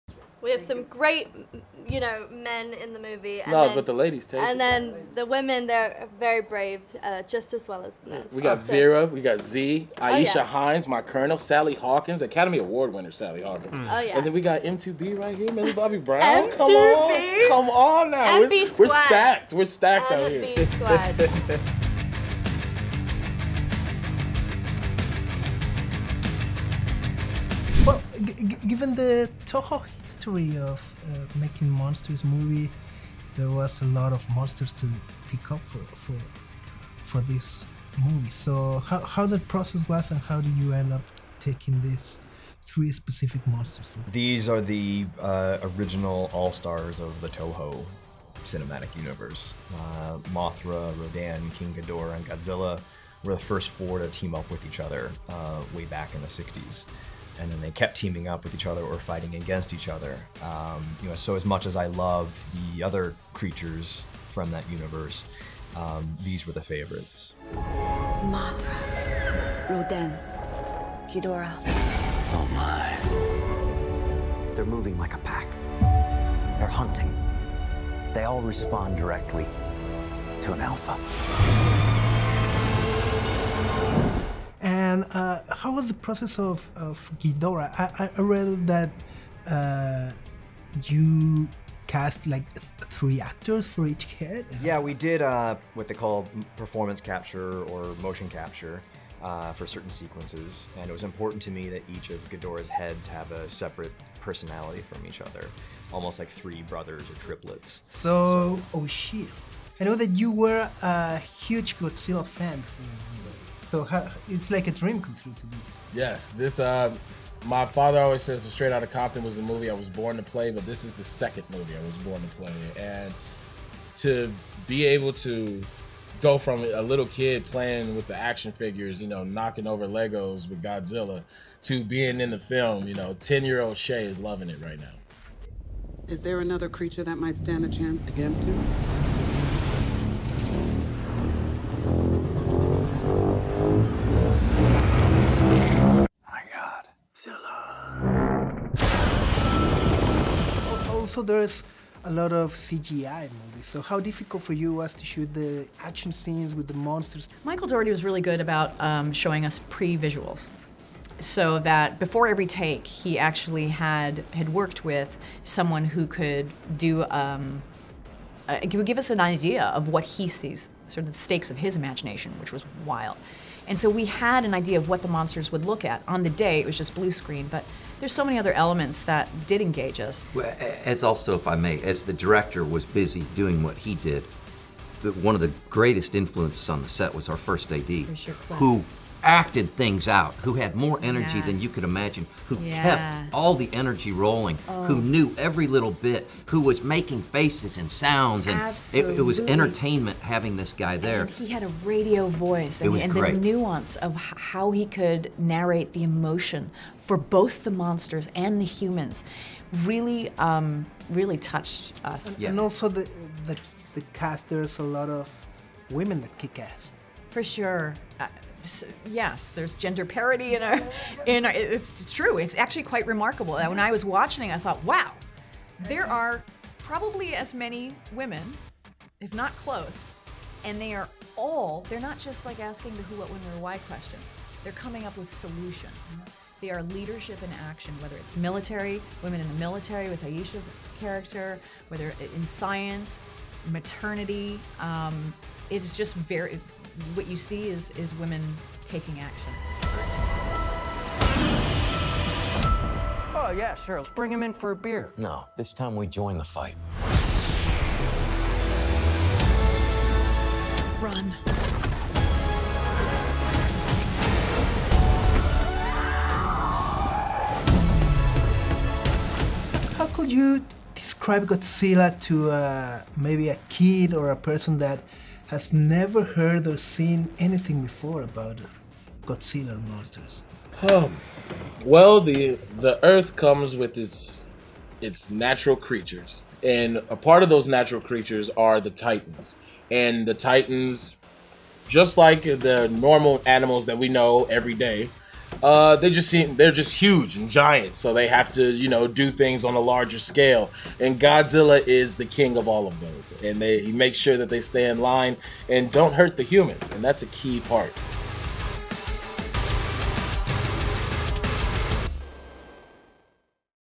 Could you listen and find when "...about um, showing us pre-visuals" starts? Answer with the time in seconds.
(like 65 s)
158 s.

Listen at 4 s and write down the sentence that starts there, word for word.
then the women, they're very brave, uh, just as well as the men.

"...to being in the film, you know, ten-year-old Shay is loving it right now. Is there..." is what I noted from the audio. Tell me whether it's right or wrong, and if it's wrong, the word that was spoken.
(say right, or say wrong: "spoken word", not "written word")
right.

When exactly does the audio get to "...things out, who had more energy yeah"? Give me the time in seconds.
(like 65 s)
189 s.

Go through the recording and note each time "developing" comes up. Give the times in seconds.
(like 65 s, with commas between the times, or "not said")
not said.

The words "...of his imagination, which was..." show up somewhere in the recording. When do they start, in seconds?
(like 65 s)
171 s.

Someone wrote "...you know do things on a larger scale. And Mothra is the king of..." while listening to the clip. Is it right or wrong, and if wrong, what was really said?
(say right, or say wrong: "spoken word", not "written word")
wrong: "Godzilla", not "Mothra".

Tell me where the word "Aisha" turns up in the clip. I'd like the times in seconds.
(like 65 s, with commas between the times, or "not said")
9 s, 240 s.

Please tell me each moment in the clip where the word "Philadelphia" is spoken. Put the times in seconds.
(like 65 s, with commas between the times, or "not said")
not said.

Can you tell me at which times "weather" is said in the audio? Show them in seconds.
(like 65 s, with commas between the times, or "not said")
not said.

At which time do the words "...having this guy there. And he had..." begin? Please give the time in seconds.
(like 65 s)
200 s.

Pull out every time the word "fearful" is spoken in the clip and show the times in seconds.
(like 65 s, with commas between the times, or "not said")
not said.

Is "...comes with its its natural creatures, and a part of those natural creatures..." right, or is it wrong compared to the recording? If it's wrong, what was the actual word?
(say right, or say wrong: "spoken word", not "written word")
right.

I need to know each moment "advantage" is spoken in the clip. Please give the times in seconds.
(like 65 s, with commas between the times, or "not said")
not said.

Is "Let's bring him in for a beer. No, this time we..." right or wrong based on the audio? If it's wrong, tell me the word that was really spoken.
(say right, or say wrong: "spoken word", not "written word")
right.